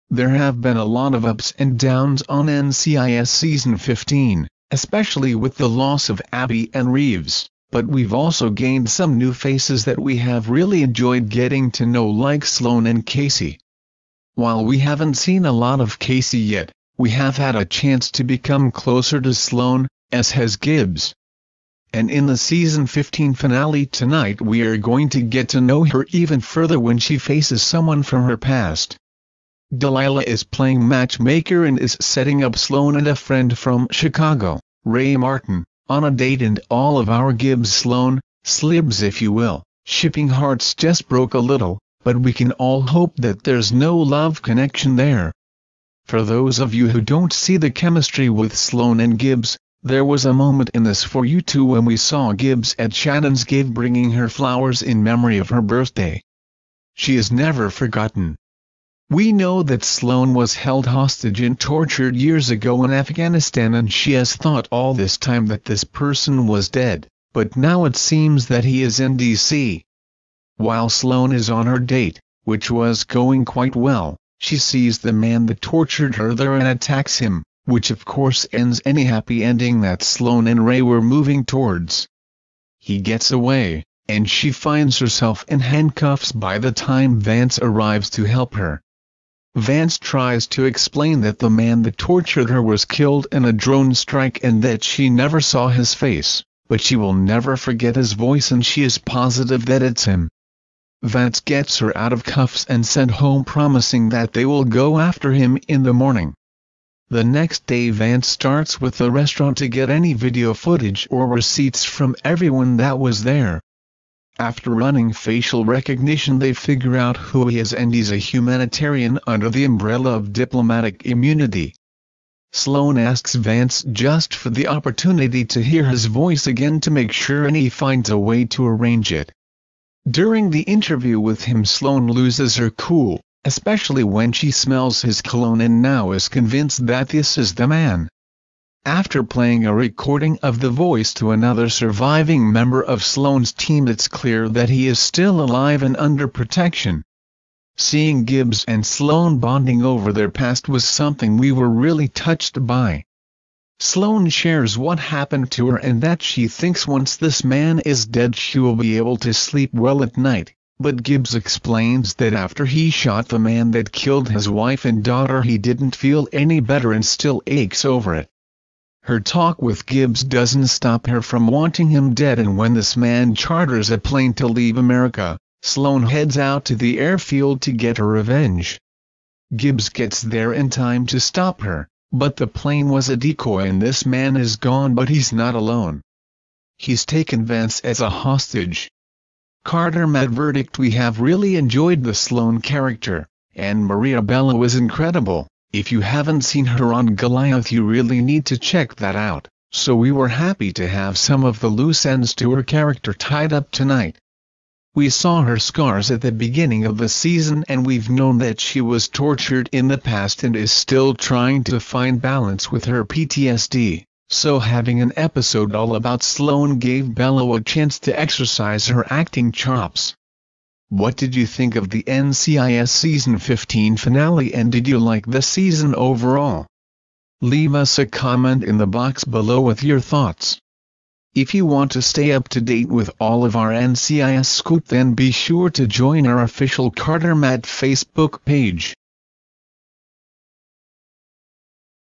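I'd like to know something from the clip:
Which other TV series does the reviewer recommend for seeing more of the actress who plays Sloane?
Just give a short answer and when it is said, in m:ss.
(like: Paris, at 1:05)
Goliath, at 3:17.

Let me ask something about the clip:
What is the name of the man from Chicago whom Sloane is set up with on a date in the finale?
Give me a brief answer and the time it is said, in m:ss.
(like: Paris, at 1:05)
Ray Martin, at 0:34.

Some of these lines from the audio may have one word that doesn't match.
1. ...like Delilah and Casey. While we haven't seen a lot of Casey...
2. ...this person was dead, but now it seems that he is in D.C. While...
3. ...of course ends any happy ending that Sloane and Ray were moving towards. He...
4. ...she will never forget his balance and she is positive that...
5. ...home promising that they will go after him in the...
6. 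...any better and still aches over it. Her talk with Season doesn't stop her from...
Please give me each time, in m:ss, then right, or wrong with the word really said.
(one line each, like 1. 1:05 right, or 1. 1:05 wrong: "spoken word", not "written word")
1. 0:12 wrong: "Sloane", not "Delilah"
2. 1:05 right
3. 1:17 right
4. 1:36 wrong: "voice", not "balance"
5. 1:43 right
6. 2:46 wrong: "Gibbs", not "Season".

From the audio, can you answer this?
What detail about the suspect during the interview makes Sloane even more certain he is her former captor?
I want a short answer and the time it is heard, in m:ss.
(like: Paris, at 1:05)
His cologne, at 2:15.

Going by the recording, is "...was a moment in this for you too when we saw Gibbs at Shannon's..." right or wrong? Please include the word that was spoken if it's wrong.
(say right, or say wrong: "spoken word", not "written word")
right.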